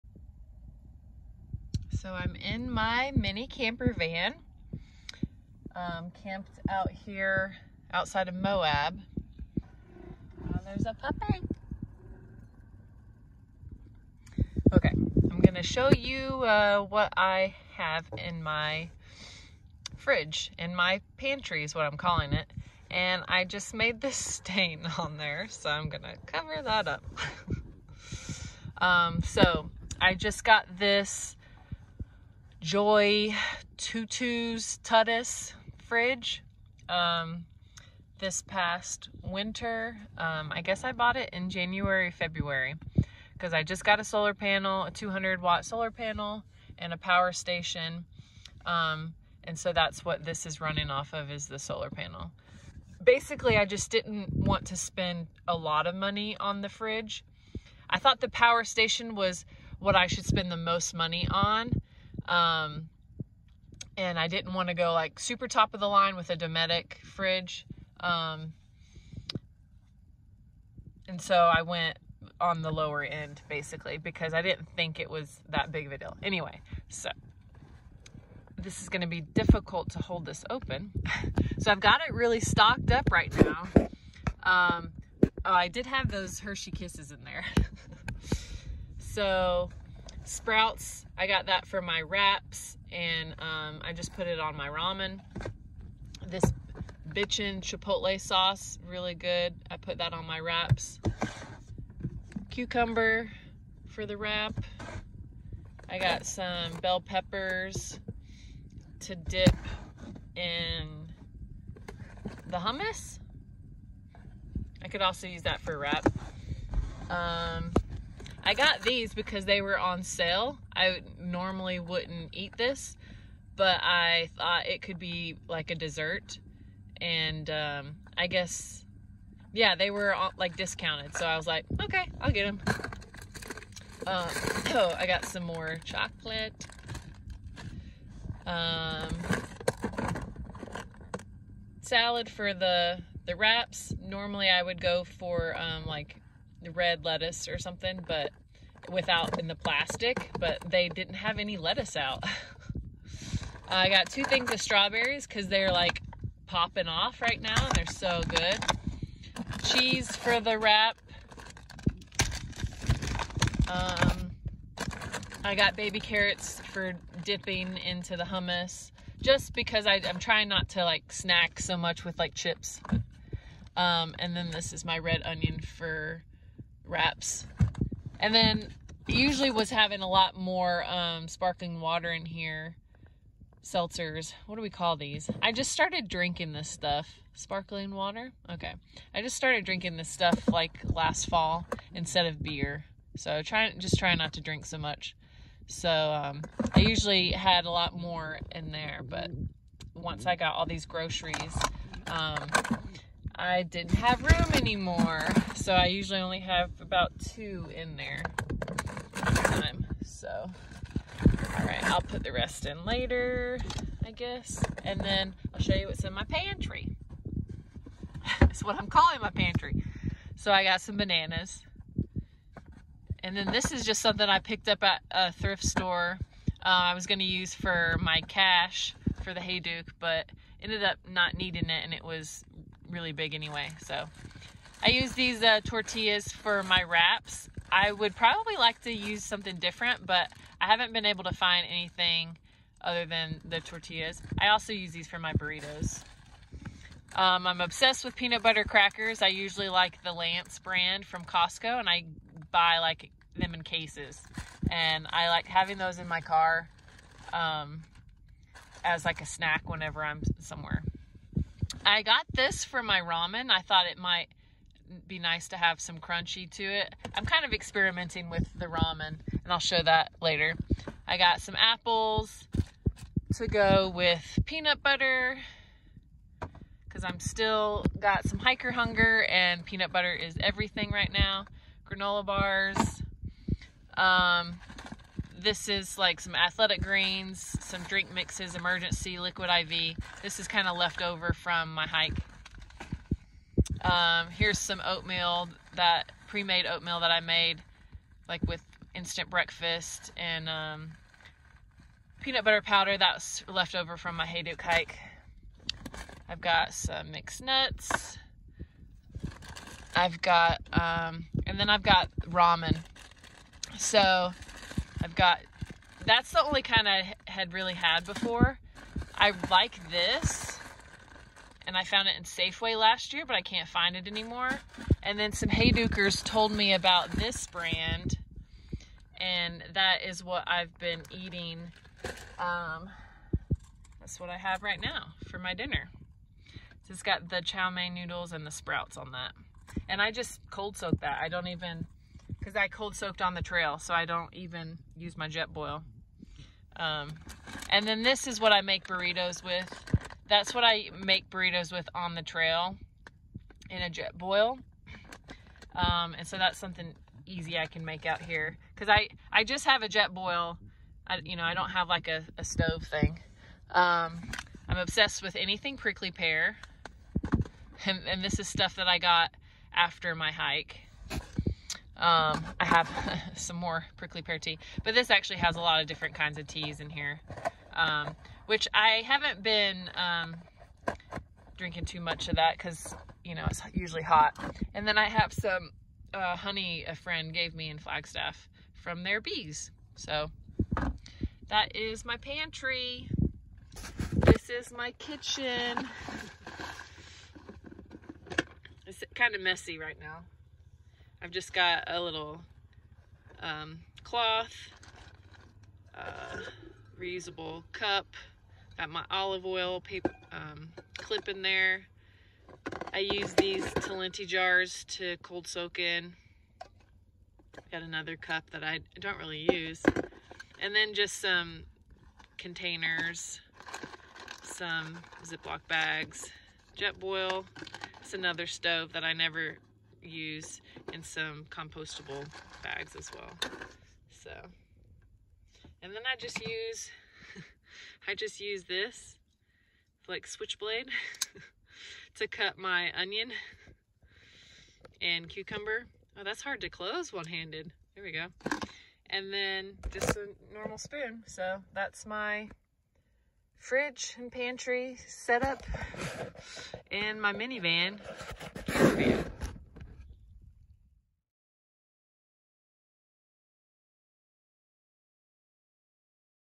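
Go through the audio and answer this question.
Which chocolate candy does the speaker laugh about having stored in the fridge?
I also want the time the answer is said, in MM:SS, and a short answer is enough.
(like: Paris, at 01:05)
Hershey Kisses, at 01:26.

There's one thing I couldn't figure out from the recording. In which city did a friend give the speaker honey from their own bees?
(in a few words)
Flagstaff.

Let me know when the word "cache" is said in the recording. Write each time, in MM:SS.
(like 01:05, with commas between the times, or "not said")
03:48.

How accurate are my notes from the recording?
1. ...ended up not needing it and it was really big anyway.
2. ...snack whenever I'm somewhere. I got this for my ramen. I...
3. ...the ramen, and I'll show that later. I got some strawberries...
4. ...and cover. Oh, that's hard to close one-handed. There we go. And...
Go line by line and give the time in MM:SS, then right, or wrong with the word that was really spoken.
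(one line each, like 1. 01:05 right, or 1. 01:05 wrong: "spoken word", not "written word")
1. 03:50 right
2. 04:19 right
3. 04:28 wrong: "apples", not "strawberries"
4. 07:25 wrong: "cucumber", not "cover".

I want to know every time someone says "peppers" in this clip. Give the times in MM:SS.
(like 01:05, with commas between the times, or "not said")
01:47.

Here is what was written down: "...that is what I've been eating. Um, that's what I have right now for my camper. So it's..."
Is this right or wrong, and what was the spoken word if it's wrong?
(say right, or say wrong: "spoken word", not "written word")
wrong: "dinner", not "camper".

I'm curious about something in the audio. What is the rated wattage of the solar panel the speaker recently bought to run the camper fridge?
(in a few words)
200 watt.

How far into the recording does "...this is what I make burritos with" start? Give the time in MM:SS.
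05:48.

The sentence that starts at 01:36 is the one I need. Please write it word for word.
This bitchin' chipotle sauce, really good.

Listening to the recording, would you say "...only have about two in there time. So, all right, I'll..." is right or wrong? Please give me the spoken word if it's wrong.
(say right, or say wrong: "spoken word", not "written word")
right.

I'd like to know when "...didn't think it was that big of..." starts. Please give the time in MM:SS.
01:14.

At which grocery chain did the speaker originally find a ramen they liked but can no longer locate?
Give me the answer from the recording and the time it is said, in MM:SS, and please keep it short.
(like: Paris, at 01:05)
Safeway, at 05:22.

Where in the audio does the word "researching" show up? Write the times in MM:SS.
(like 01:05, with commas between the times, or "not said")
not said.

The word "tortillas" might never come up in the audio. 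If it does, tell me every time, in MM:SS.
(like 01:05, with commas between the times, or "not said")
03:55, 04:03.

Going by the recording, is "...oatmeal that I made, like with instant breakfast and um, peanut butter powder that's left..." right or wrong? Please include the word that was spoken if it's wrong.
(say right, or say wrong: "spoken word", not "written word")
right.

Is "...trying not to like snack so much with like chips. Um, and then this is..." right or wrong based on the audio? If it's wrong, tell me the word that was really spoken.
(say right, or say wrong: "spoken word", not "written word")
right.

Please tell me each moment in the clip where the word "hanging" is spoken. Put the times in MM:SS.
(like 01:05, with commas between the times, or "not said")
not said.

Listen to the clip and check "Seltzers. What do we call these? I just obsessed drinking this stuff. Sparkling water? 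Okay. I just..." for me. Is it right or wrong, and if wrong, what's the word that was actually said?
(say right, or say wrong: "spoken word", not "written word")
wrong: "started", not "obsessed".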